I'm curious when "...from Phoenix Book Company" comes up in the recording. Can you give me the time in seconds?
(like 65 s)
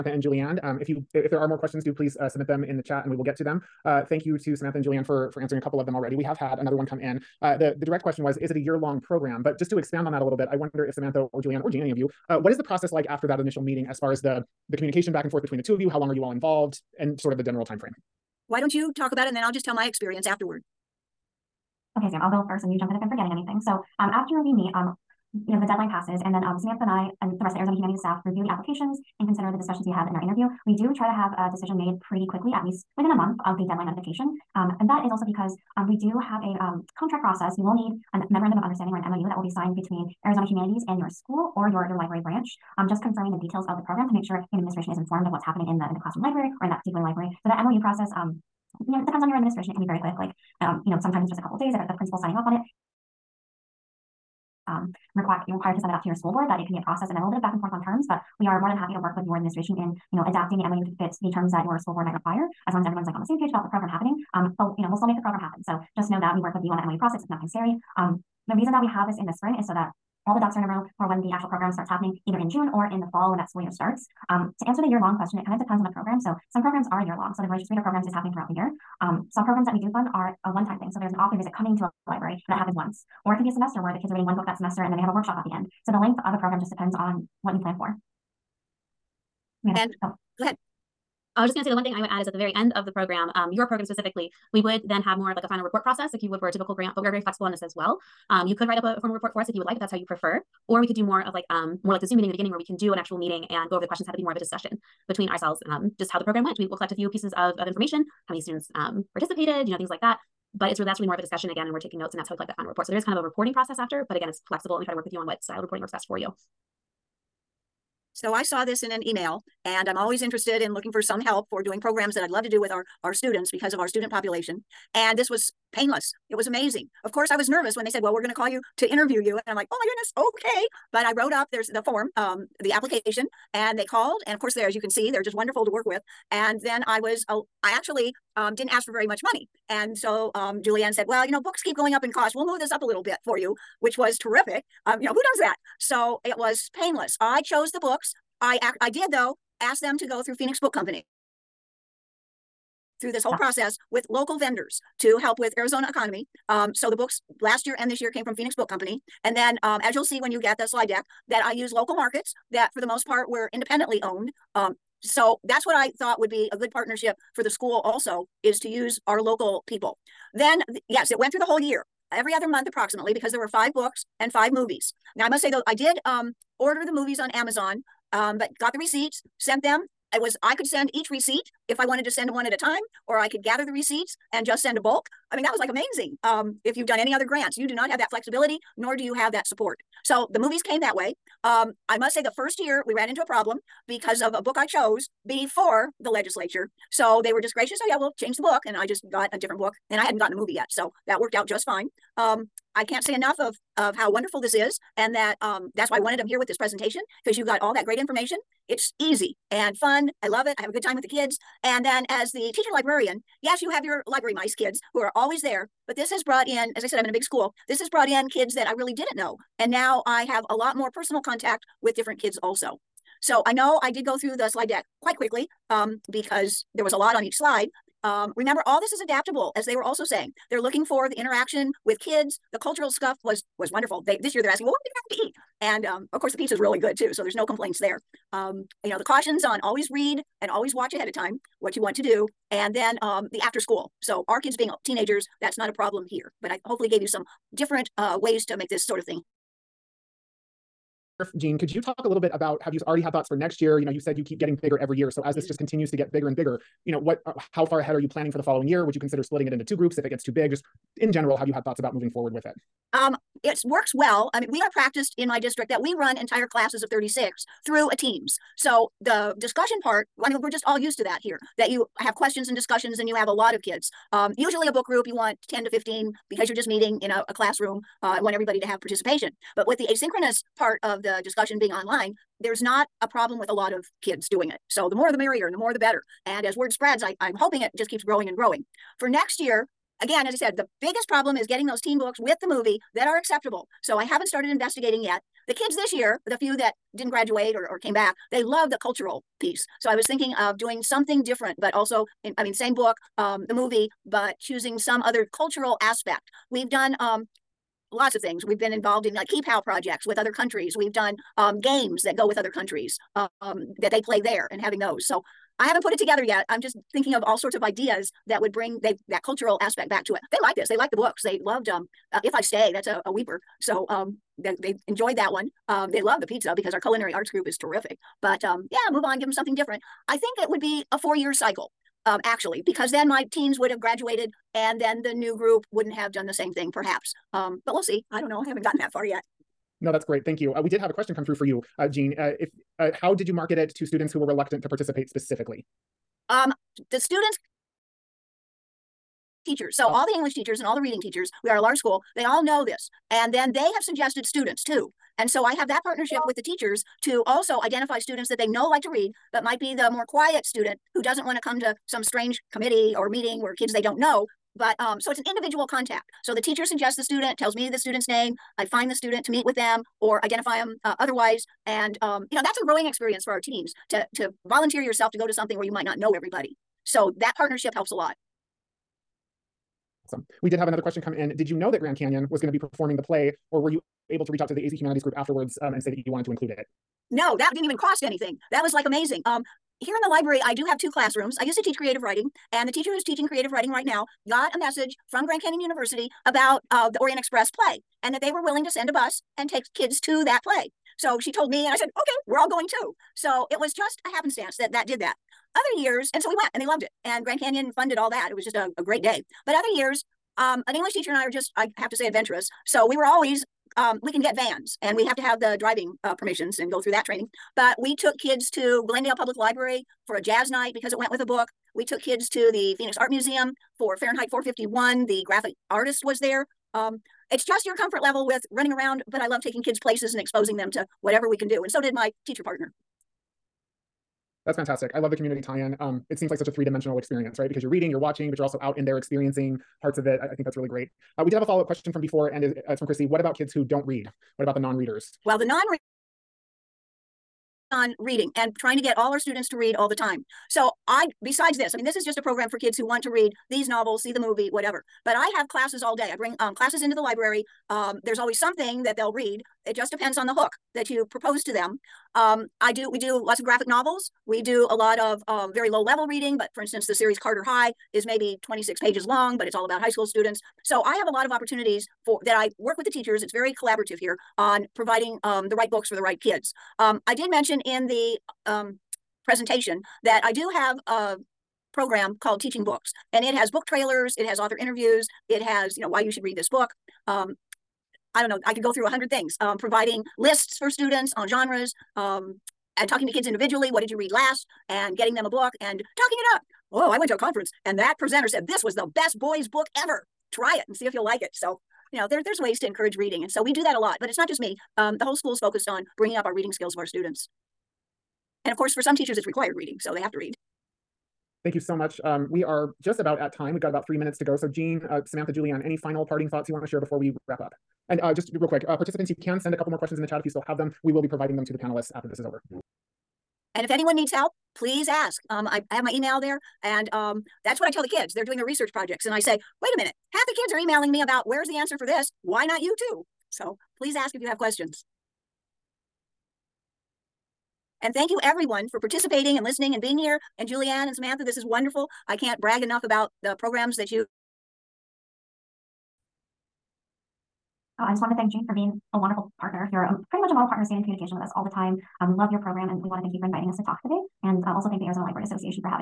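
158 s.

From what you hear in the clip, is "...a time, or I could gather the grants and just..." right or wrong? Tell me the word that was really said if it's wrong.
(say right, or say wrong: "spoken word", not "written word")
wrong: "receipts", not "grants".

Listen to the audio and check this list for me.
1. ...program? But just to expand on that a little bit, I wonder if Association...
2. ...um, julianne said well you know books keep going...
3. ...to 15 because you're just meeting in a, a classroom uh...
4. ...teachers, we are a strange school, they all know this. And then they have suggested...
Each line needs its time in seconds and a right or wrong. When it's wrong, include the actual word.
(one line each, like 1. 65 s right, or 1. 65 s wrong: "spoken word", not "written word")
1. 9 s wrong: "Samantha", not "Association"
2. 140 s right
3. 275 s right
4. 351 s wrong: "large", not "strange".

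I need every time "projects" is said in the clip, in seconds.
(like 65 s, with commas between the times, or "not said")
309 s, 528 s.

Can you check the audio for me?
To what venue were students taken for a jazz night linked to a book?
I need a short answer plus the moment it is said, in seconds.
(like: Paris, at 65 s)
Glendale Public Library, at 418 s.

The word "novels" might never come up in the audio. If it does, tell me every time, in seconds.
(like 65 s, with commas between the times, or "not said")
453 s, 463 s.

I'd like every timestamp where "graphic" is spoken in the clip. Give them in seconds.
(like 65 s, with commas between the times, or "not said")
425 s, 463 s.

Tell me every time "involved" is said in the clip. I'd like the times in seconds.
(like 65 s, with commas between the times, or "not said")
16 s, 308 s.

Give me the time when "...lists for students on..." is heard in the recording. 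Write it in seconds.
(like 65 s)
490 s.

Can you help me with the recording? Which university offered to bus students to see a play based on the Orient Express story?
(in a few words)
Grand Canyon University.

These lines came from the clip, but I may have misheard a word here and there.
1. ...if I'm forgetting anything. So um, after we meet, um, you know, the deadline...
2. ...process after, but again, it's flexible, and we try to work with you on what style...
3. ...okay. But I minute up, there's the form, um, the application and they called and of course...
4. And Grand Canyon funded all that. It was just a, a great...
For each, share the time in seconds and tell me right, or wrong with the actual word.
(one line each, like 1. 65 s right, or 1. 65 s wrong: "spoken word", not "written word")
1. 22 s right
2. 113 s right
3. 130 s wrong: "wrote", not "minute"
4. 407 s right.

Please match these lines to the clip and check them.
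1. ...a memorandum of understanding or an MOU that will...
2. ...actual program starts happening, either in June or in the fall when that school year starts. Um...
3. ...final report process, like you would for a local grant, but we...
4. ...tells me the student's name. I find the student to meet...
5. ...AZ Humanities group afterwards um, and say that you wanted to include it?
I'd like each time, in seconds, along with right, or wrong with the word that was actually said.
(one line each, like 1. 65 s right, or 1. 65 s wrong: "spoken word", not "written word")
1. 38 s right
2. 71 s right
3. 95 s wrong: "typical", not "local"
4. 367 s right
5. 384 s right.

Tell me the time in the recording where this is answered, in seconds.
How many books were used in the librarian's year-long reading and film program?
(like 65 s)
173 s.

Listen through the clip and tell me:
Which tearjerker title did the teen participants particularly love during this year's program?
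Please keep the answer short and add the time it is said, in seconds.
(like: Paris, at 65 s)
If I Stay, at 322 s.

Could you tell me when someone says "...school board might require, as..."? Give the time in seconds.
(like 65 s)
61 s.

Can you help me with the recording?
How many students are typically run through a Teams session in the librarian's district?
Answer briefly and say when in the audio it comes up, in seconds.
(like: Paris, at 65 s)
36, at 266 s.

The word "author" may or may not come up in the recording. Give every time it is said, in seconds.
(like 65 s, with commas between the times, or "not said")
81 s, 484 s.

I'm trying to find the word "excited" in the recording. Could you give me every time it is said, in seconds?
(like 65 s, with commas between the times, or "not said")
not said.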